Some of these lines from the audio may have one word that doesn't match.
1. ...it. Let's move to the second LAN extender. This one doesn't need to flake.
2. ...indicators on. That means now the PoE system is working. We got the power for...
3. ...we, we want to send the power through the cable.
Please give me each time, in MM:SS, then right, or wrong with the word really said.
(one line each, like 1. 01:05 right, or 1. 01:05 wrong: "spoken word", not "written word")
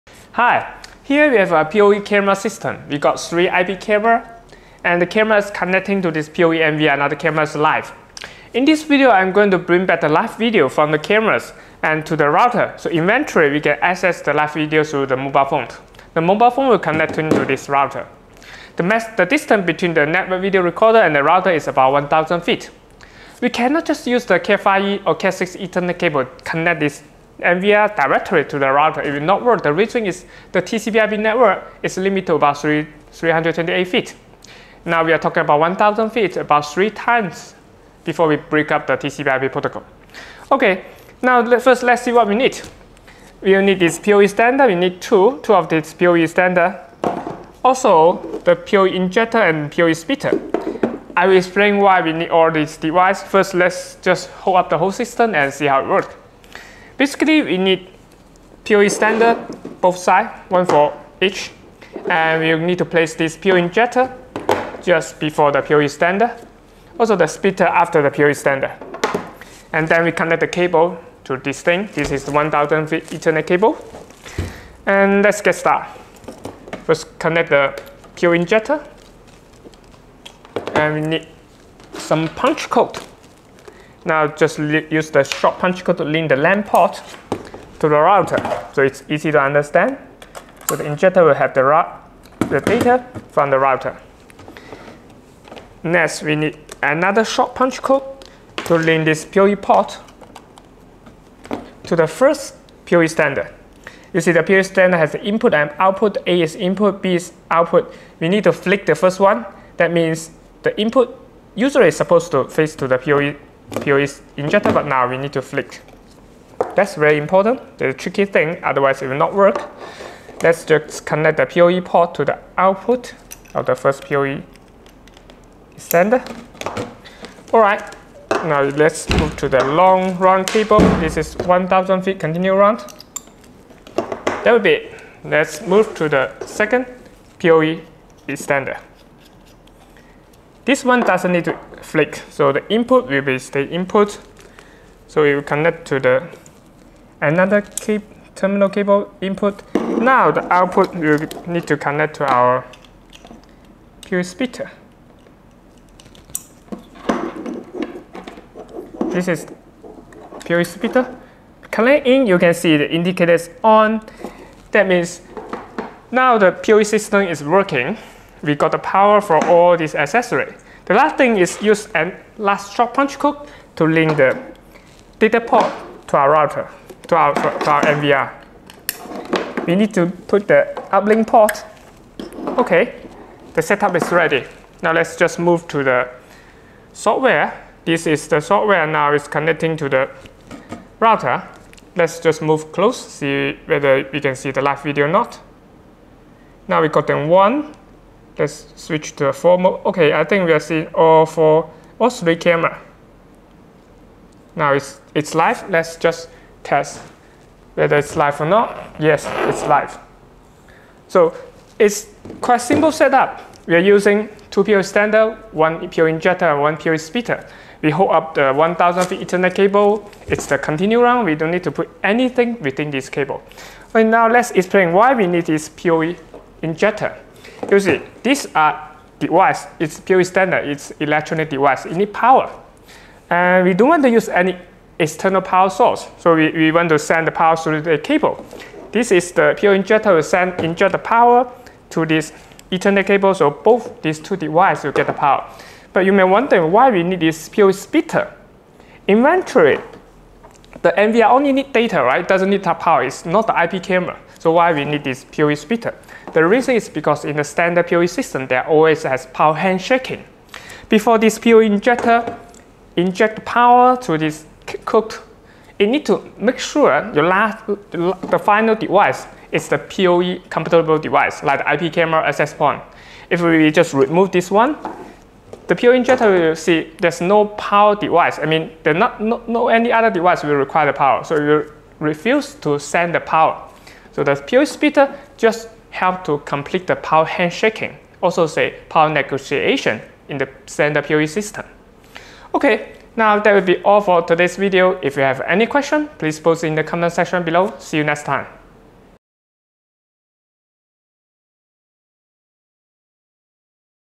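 1. 02:14 wrong: "PoE", not "LAN"
2. 02:42 right
3. 03:56 right.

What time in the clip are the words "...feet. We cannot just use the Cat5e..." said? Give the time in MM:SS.
00:22.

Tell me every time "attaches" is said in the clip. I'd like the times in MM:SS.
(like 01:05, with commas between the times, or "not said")
not said.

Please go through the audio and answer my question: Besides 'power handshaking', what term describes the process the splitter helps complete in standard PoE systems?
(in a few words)
power negotiation.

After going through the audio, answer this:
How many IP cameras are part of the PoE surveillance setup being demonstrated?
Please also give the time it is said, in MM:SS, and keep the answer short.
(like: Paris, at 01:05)
3, at 00:03.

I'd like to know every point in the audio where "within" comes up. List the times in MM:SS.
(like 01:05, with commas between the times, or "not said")
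03:42.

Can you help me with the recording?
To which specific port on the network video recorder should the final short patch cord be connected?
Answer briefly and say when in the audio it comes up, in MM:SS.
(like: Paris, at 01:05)
uplink port, at 03:00.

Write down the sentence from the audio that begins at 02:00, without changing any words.
Let's just connect the PoE port to the output of the first PoE extender.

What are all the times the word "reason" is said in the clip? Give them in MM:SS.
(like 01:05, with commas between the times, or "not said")
00:29, 04:16.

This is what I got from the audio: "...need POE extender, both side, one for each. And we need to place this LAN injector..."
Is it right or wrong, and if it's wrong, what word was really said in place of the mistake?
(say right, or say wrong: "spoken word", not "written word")
wrong: "POE", not "LAN".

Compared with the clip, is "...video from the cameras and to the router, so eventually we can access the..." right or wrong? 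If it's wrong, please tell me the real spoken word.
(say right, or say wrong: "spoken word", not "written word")
right.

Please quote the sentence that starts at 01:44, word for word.
You see the PoE extender has the input and output.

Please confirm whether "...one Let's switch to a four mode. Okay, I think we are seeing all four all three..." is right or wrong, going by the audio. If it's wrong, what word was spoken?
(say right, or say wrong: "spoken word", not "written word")
right.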